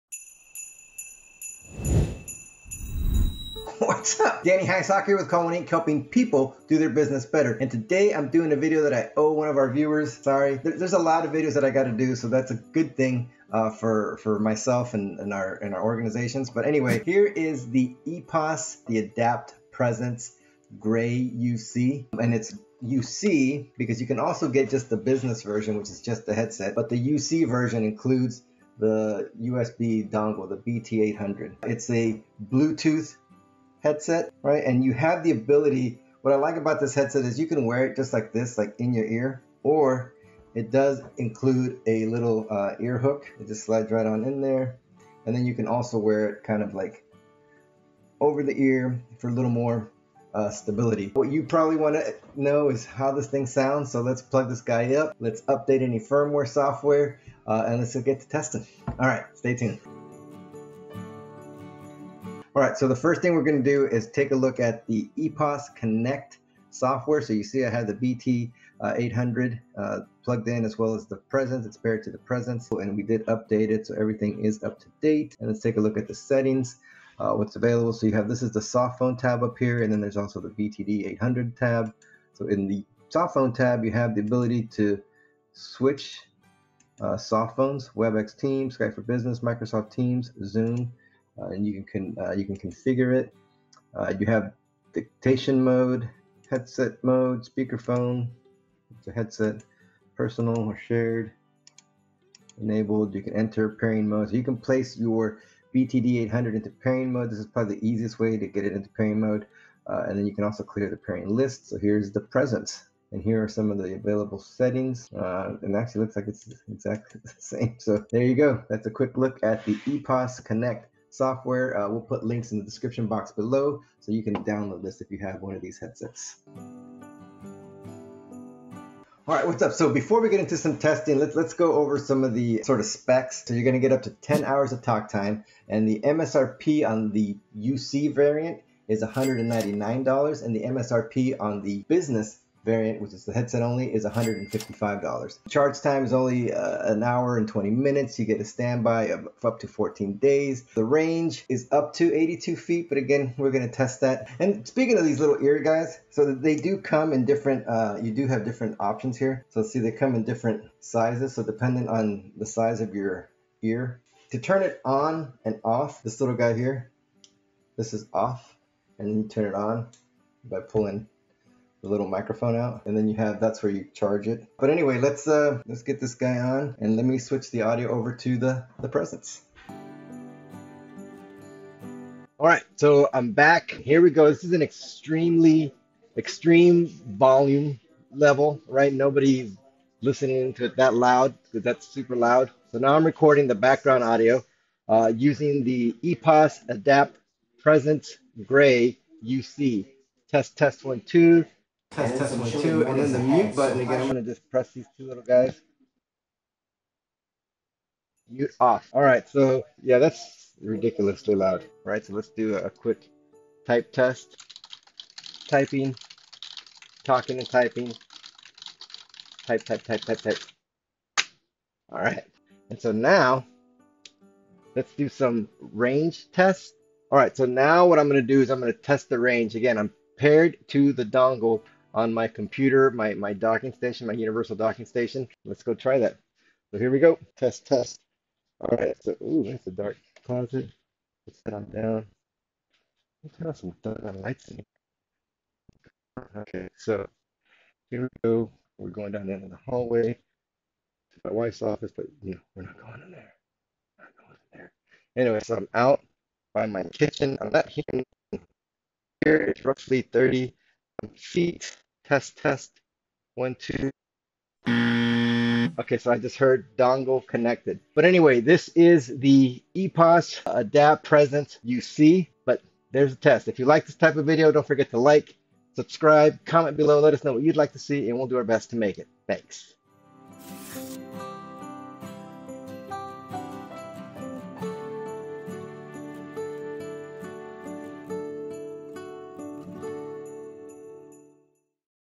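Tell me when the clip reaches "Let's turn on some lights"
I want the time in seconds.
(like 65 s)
243 s.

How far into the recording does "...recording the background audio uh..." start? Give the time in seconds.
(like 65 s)
193 s.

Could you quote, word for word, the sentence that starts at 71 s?
It's paired to the presence and we did update it.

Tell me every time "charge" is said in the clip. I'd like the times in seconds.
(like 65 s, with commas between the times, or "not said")
145 s, 173 s.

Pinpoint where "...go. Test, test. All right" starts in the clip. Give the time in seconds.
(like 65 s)
236 s.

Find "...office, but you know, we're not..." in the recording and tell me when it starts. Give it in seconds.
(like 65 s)
251 s.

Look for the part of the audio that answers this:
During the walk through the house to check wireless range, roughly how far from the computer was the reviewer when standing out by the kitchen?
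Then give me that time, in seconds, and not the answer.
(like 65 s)
260 s.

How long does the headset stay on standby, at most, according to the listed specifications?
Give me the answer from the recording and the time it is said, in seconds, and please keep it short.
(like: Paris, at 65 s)
14 days, at 149 s.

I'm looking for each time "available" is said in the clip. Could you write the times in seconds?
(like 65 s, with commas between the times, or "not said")
77 s, 113 s.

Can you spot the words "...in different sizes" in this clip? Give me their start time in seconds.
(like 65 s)
160 s.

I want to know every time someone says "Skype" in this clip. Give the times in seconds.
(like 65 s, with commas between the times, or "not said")
88 s.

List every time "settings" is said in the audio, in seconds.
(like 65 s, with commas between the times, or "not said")
76 s, 114 s.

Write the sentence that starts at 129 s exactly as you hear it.
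So before we get into some testing, let's let's go over some of the sort of specs.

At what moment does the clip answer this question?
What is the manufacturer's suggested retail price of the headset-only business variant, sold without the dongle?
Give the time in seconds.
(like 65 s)
144 s.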